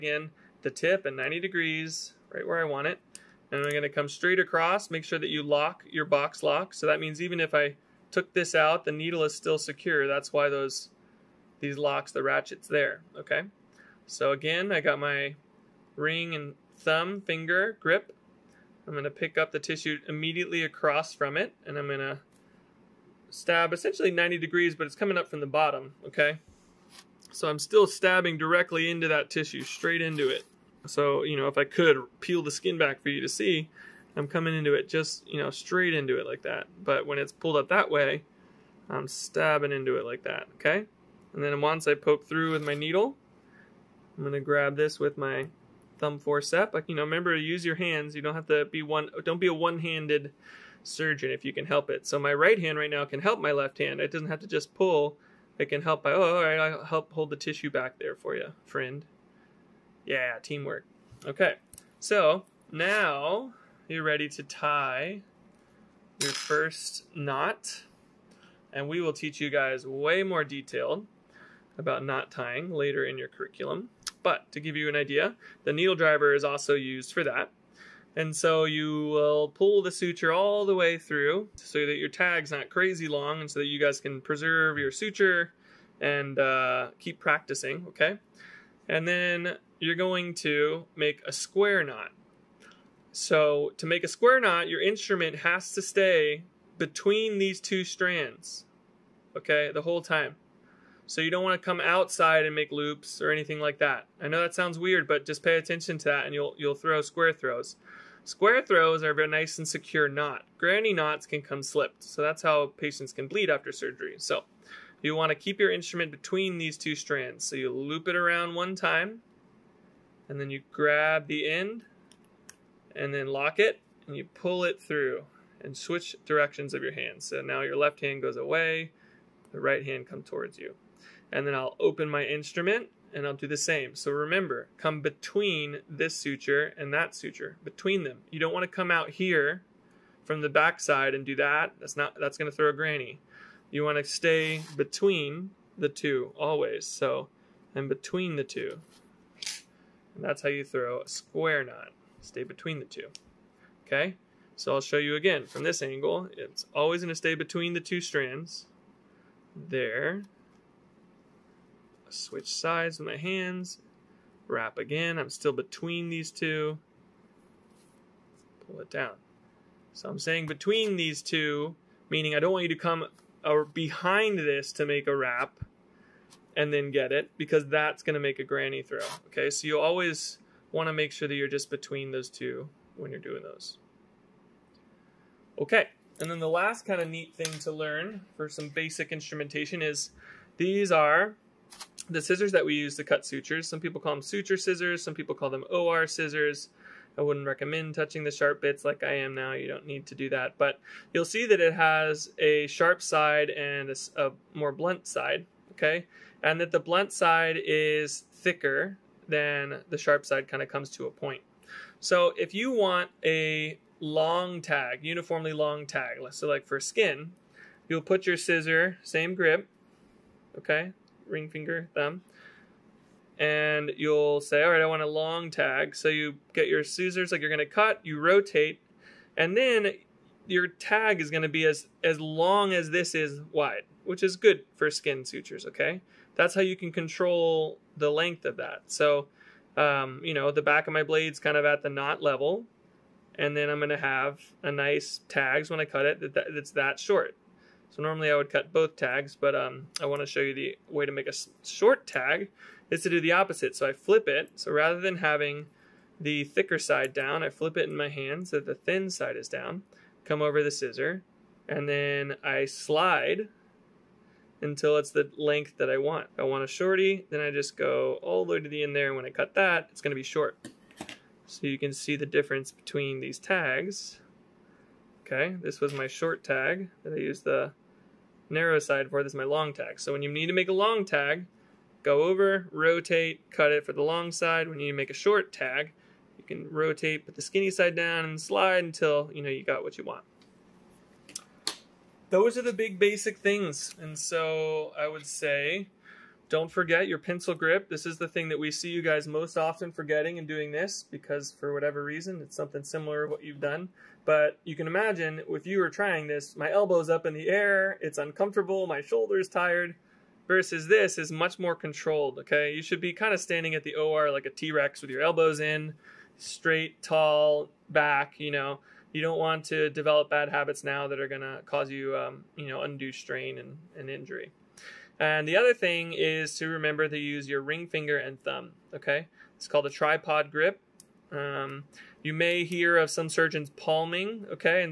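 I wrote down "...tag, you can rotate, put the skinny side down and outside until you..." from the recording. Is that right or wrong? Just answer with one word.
wrong.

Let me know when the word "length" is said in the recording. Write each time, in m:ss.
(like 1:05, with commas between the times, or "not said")
3:58, 4:25.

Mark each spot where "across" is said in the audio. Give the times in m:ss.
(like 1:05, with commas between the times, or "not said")
0:04, 0:20.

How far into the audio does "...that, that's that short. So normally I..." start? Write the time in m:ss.
4:06.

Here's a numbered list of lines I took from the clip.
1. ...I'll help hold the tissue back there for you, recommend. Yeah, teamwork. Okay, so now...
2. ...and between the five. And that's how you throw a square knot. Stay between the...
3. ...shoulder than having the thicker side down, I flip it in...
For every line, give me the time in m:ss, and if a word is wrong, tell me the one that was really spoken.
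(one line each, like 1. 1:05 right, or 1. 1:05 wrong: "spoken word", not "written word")
1. 0:56 wrong: "friend", not "recommend"
2. 2:27 wrong: "two", not "five"
3. 4:14 wrong: "rather", not "shoulder".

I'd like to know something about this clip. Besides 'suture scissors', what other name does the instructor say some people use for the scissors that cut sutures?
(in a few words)
OR scissors.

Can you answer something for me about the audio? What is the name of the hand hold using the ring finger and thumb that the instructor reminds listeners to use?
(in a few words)
Tripod grip.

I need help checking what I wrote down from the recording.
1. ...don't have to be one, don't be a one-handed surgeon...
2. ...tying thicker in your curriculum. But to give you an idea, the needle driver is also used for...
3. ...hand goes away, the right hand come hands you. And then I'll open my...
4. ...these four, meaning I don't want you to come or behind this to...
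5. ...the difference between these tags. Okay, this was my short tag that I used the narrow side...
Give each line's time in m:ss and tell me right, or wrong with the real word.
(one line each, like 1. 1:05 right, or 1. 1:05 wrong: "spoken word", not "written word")
1. 0:48 right
2. 1:12 wrong: "later", not "thicker"
3. 2:07 wrong: "towards", not "hands"
4. 2:50 wrong: "two", not "four"
5. 4:32 right.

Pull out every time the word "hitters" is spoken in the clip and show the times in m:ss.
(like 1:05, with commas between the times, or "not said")
not said.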